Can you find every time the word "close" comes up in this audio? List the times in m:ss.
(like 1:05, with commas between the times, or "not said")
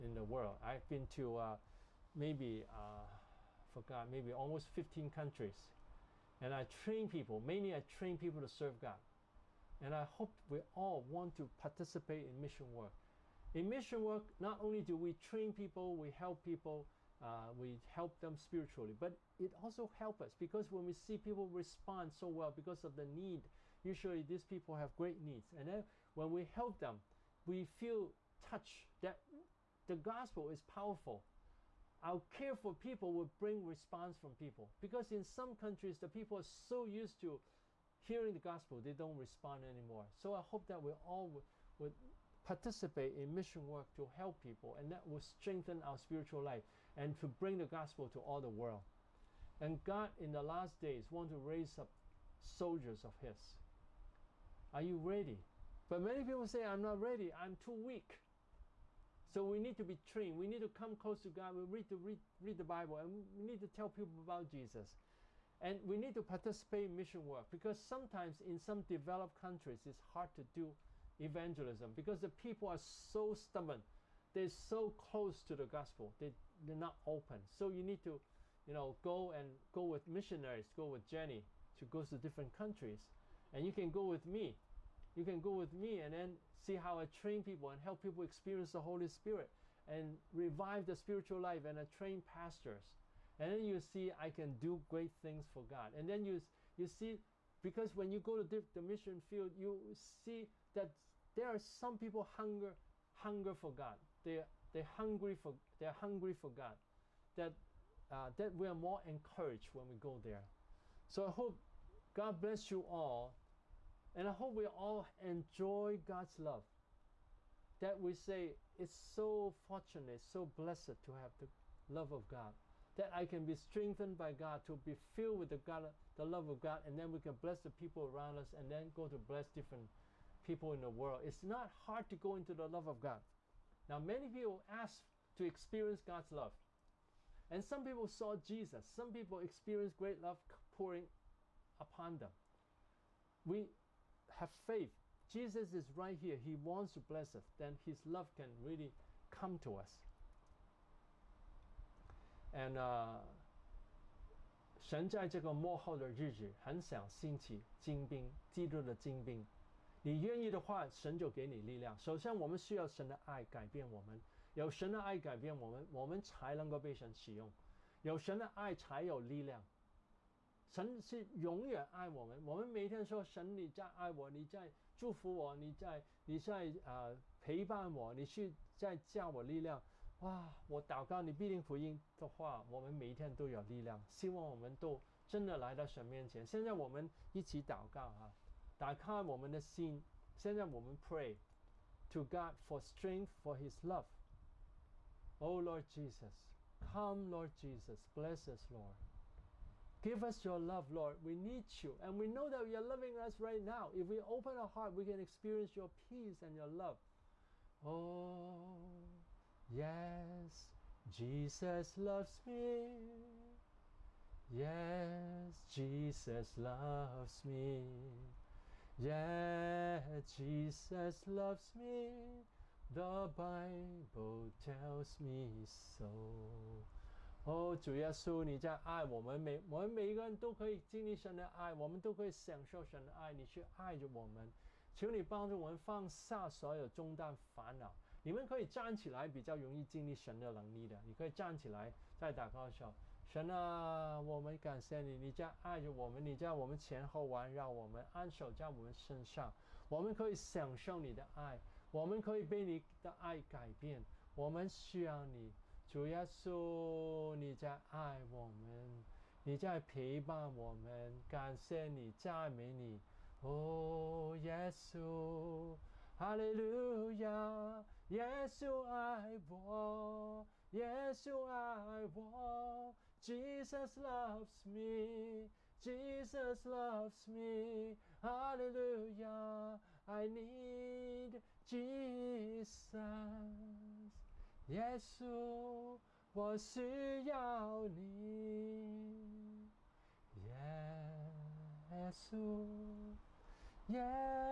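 1:00, 1:14.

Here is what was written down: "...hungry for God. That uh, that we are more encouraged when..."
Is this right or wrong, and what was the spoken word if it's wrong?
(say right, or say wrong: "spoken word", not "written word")
right.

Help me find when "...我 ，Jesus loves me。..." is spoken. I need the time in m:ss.
4:32.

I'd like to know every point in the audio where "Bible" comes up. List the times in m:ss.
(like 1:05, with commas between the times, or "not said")
1:02, 3:43.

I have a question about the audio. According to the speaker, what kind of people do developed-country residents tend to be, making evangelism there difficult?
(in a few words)
stubborn.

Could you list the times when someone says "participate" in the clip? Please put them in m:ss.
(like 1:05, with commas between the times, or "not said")
0:11, 0:42, 1:06.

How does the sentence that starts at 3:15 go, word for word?
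Oh Lord Jesus, come Lord Jesus, bless us Lord.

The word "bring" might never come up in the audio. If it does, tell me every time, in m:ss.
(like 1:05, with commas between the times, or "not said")
0:33, 0:47.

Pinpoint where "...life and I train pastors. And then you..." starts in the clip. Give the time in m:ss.
1:31.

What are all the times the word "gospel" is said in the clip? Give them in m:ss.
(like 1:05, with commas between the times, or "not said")
0:29, 0:38, 0:47, 1:15.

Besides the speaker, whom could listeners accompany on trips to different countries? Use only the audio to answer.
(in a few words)
Jenny.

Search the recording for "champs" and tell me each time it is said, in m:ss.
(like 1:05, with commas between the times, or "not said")
not said.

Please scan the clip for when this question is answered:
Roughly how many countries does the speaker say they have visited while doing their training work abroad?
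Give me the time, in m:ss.
0:04.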